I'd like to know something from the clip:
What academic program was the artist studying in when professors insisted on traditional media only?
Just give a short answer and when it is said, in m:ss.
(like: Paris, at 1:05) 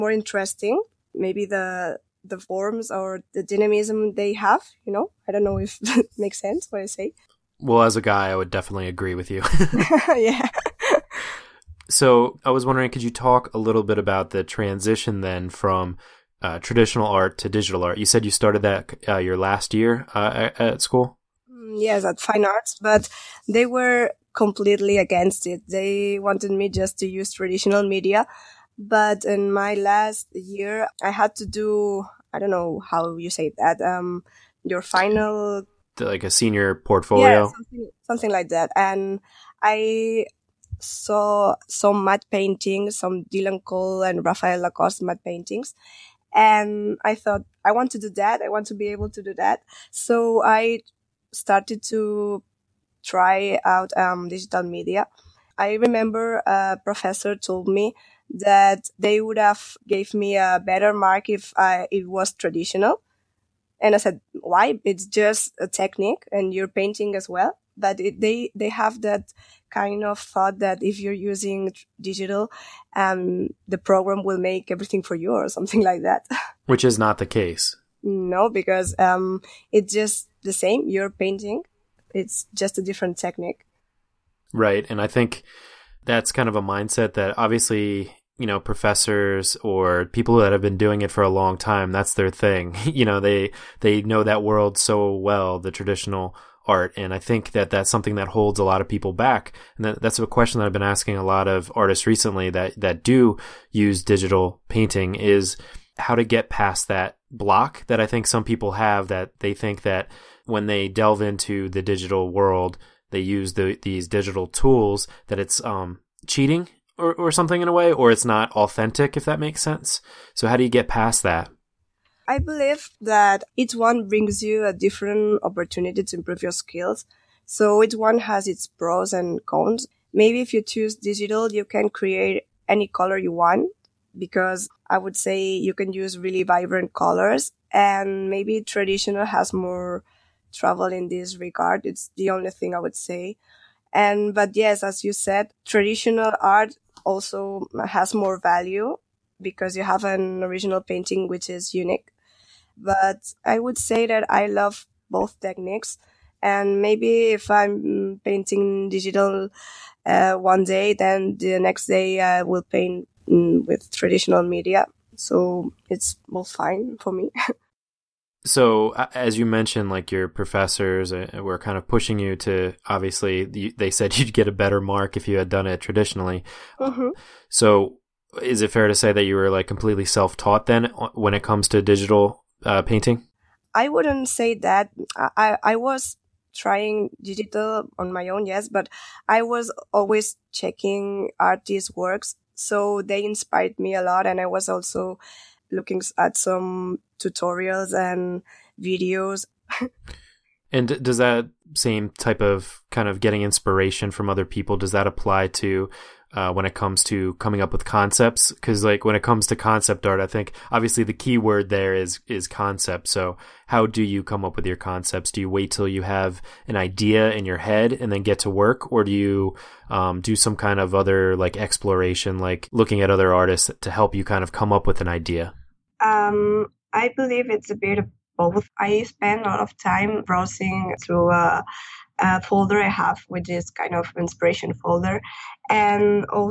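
Fine Arts, at 0:22.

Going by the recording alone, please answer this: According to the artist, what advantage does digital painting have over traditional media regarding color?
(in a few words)
really vibrant colors.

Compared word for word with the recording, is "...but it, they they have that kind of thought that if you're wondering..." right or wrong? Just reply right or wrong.
wrong.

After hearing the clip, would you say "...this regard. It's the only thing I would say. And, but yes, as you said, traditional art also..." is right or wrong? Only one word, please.
right.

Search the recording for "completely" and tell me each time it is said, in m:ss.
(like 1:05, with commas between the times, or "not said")
0:24, 2:59.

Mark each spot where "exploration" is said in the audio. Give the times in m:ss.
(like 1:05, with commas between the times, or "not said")
3:41.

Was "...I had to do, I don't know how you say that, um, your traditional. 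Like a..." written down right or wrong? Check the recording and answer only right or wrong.
wrong.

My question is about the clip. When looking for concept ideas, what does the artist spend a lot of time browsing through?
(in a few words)
inspiration folder.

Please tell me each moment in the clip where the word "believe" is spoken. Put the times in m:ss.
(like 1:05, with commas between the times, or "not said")
2:02, 3:47.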